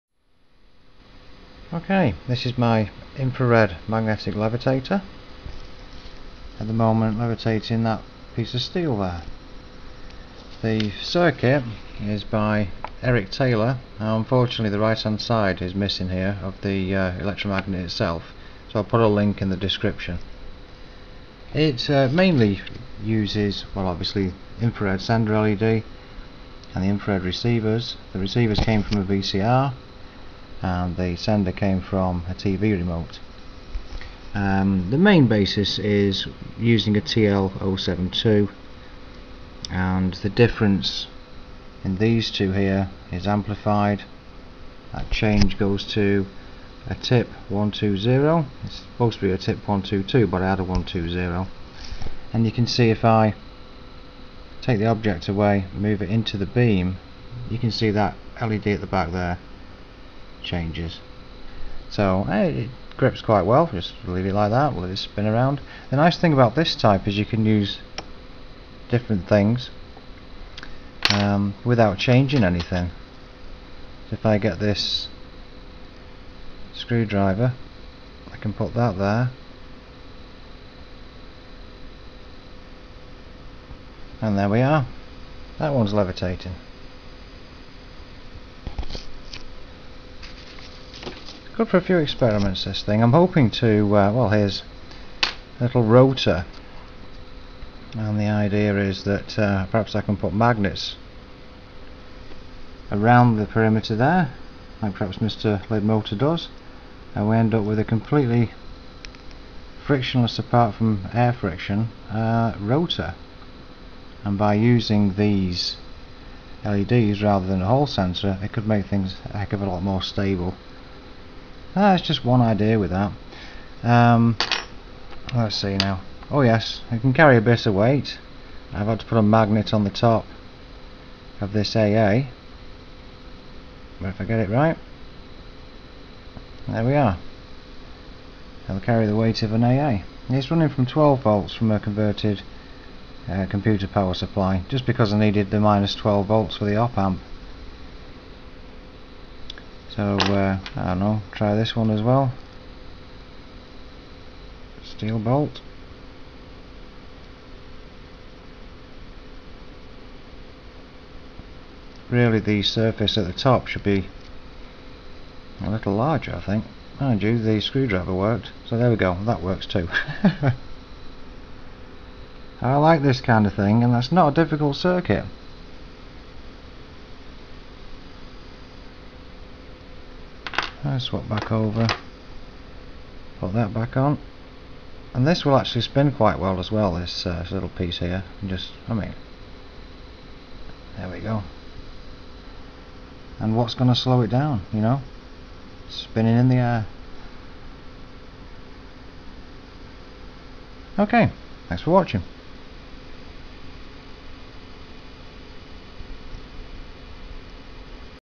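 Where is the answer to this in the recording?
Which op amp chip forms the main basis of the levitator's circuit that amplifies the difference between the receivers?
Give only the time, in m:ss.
0:37.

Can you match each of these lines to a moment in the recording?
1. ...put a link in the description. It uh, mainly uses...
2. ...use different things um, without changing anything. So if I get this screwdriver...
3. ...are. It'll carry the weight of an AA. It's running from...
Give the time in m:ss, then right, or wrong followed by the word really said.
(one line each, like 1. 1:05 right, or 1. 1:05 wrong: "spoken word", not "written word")
1. 0:18 right
2. 1:07 right
3. 2:16 right.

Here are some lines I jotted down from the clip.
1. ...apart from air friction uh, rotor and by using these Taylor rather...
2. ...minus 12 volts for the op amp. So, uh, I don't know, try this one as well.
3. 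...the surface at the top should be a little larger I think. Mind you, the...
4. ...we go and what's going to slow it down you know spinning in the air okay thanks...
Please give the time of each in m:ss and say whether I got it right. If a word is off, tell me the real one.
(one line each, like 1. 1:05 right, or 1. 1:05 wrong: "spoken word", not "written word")
1. 1:50 wrong: "LEDs", not "Taylor"
2. 2:25 right
3. 2:42 right
4. 3:11 right.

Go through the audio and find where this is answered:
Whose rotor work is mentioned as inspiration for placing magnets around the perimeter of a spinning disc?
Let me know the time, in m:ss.
1:45.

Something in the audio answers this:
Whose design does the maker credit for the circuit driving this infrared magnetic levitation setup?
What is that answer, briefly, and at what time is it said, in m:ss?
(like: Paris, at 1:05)
Eric Taylor, at 0:13.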